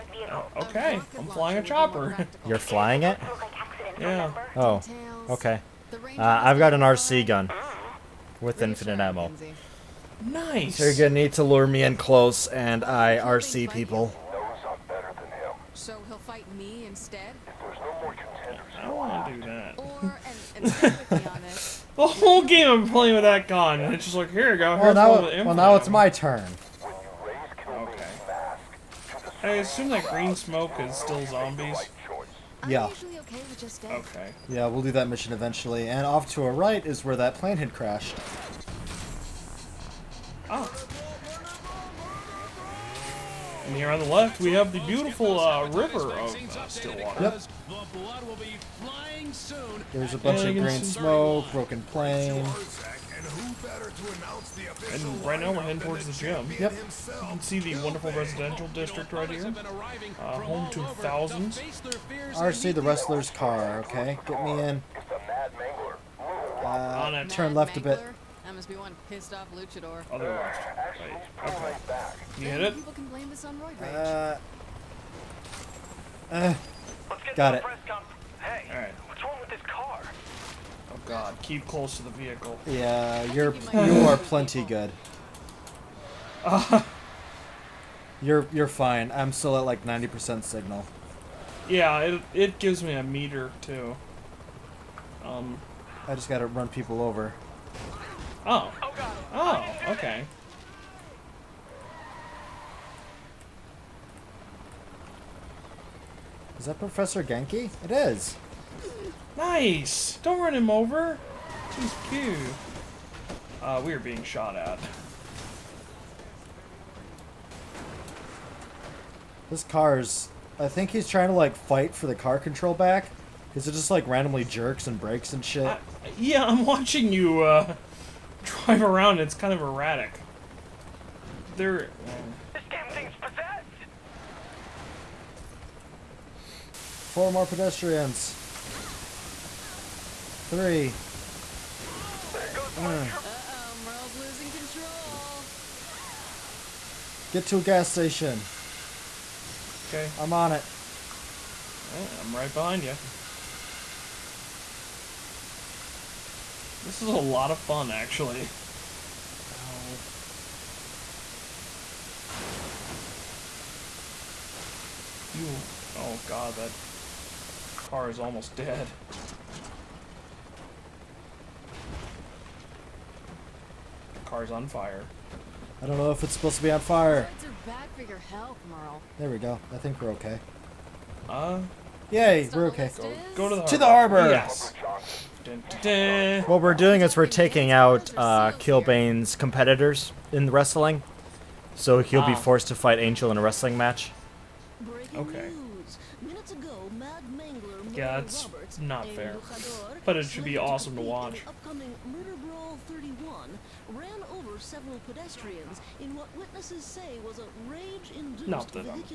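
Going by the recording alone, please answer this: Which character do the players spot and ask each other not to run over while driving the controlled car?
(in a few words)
Professor Genki.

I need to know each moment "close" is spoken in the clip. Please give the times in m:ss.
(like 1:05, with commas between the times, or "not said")
0:11, 1:21.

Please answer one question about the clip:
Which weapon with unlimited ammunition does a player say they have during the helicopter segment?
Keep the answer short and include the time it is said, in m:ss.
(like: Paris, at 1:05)
RC gun, at 0:06.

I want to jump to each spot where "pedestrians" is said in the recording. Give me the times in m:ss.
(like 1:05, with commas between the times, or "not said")
2:17, 3:25.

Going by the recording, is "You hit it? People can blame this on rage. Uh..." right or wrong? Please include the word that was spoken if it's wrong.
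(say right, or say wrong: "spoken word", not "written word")
right.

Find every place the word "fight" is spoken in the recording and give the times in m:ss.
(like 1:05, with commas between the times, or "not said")
0:16, 2:01, 3:12.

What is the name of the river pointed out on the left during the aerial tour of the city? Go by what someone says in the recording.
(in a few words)
Stillwater.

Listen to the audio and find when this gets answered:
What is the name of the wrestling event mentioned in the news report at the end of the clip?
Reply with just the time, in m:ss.
3:22.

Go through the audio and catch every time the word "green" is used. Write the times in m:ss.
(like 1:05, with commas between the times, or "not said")
0:30, 0:50.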